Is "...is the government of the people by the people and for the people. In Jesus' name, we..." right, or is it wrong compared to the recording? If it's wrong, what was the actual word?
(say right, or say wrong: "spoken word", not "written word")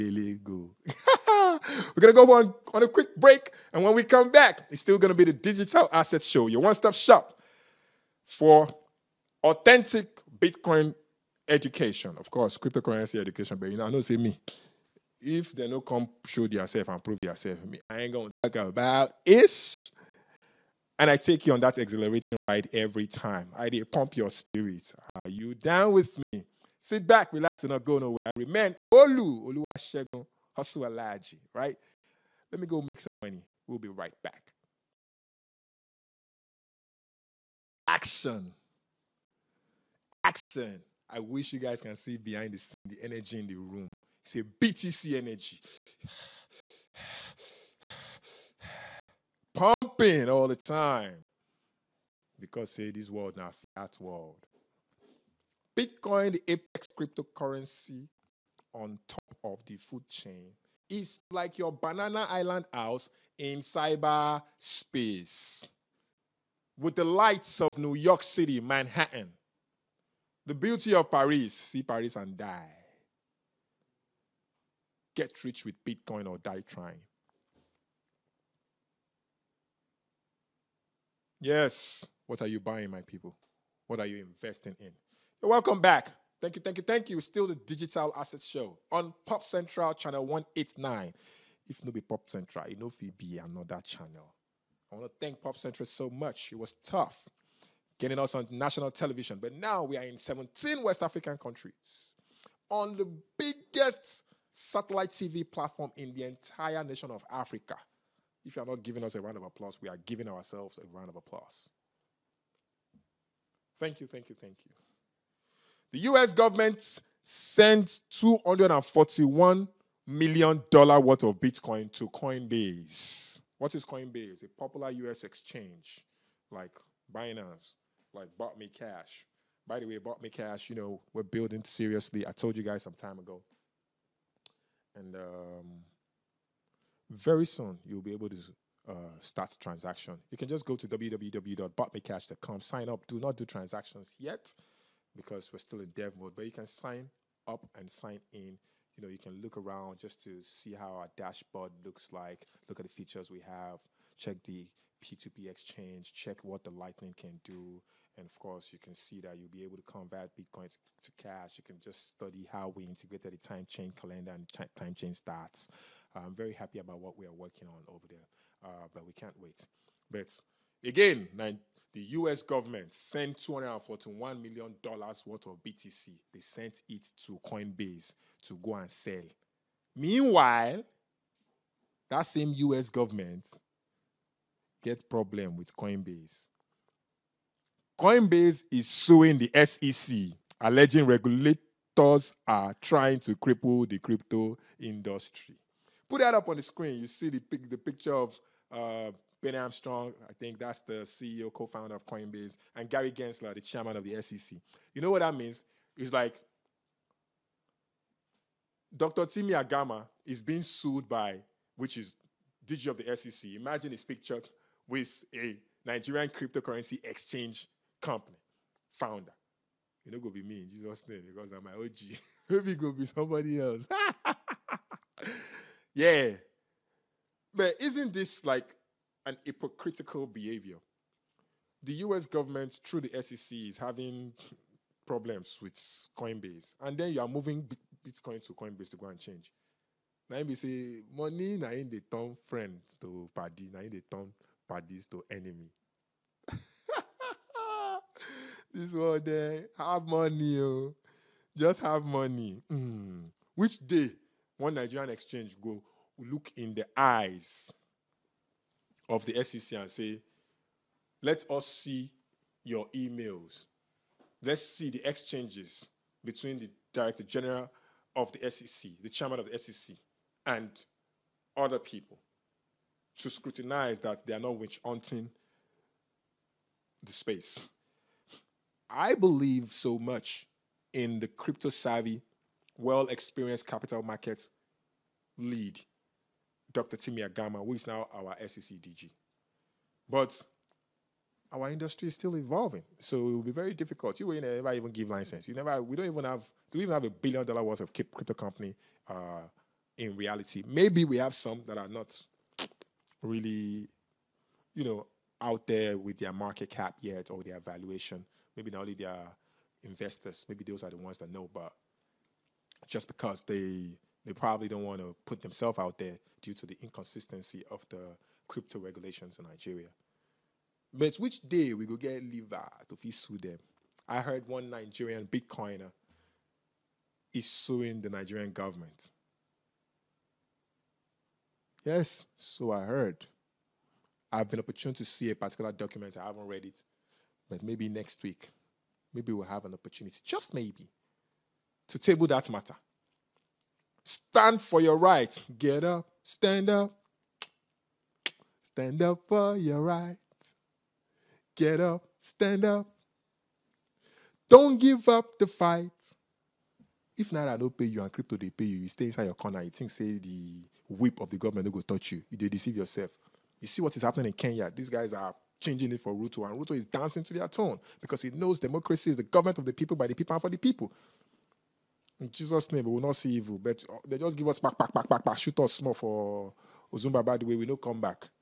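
right.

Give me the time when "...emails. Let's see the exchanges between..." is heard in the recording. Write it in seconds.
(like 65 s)
262 s.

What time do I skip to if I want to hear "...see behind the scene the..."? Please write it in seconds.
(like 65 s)
41 s.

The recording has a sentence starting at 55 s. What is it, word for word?
Bitcoin, the apex cryptocurrency on top of the food chain, is like your banana island house in cyber space.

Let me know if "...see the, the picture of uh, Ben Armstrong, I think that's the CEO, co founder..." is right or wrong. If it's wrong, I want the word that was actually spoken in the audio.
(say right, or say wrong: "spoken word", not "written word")
right.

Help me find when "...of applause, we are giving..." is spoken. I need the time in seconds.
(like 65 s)
109 s.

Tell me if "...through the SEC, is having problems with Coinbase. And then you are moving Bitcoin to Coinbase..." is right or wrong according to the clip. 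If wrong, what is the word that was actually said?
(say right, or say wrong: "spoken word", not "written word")
right.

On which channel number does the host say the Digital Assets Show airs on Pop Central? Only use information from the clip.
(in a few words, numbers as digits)
189.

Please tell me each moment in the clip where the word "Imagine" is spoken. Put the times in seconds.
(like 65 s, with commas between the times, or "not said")
213 s.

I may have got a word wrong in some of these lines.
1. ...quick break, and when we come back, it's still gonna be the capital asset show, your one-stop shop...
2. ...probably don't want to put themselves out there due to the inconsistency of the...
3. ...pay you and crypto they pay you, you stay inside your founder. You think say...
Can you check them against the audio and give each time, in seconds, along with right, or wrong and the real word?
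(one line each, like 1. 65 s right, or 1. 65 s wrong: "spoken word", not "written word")
1. 2 s wrong: "digital", not "capital"
2. 314 s right
3. 357 s wrong: "corner", not "founder".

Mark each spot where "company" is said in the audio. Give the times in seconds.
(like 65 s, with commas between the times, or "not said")
218 s, 298 s.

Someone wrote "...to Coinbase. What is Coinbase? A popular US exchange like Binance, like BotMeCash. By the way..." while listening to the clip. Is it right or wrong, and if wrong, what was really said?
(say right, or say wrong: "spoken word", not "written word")
right.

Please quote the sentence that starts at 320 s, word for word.
But which day we go get liver to fit sue them?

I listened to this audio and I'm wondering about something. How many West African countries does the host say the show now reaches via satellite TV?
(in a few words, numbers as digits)
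17.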